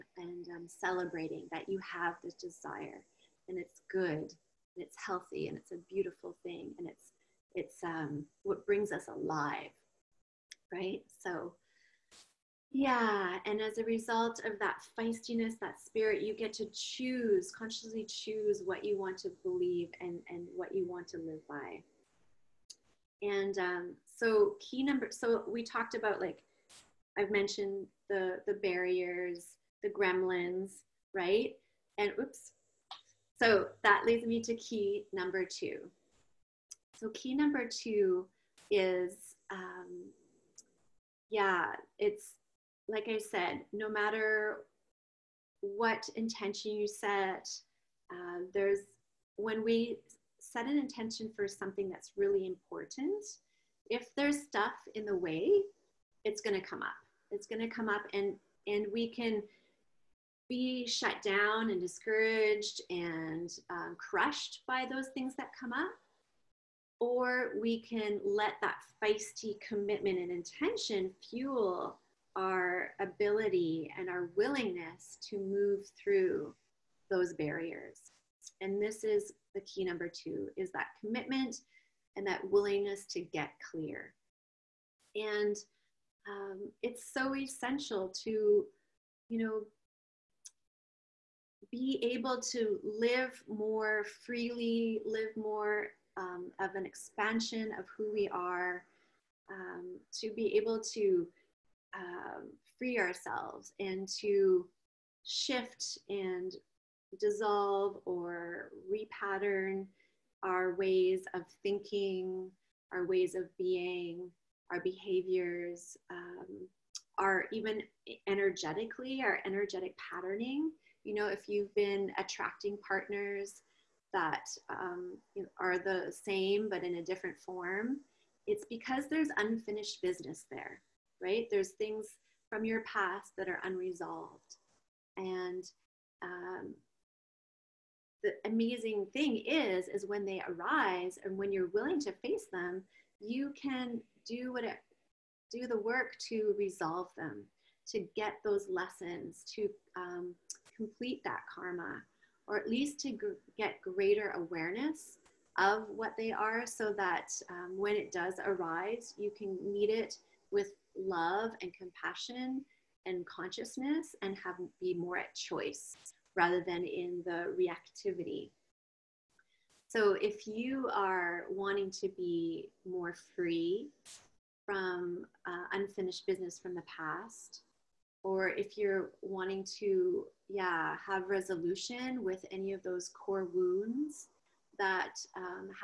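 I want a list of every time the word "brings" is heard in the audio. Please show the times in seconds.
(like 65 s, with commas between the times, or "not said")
8 s.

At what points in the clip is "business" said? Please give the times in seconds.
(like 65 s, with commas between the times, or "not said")
130 s, 176 s.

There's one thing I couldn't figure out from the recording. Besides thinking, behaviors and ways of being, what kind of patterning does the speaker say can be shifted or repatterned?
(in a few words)
energetic patterning.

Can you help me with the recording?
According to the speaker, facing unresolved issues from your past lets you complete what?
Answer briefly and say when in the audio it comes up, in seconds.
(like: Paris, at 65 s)
karma, at 151 s.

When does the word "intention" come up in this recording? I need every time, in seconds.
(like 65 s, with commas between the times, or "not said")
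46 s, 50 s, 70 s.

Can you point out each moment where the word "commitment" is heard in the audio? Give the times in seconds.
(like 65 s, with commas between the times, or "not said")
69 s, 81 s.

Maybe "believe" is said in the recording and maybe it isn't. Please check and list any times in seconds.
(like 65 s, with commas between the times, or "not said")
19 s.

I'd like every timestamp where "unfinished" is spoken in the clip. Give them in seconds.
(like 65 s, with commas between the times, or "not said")
129 s, 175 s.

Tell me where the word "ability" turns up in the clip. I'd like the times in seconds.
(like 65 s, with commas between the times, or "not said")
73 s.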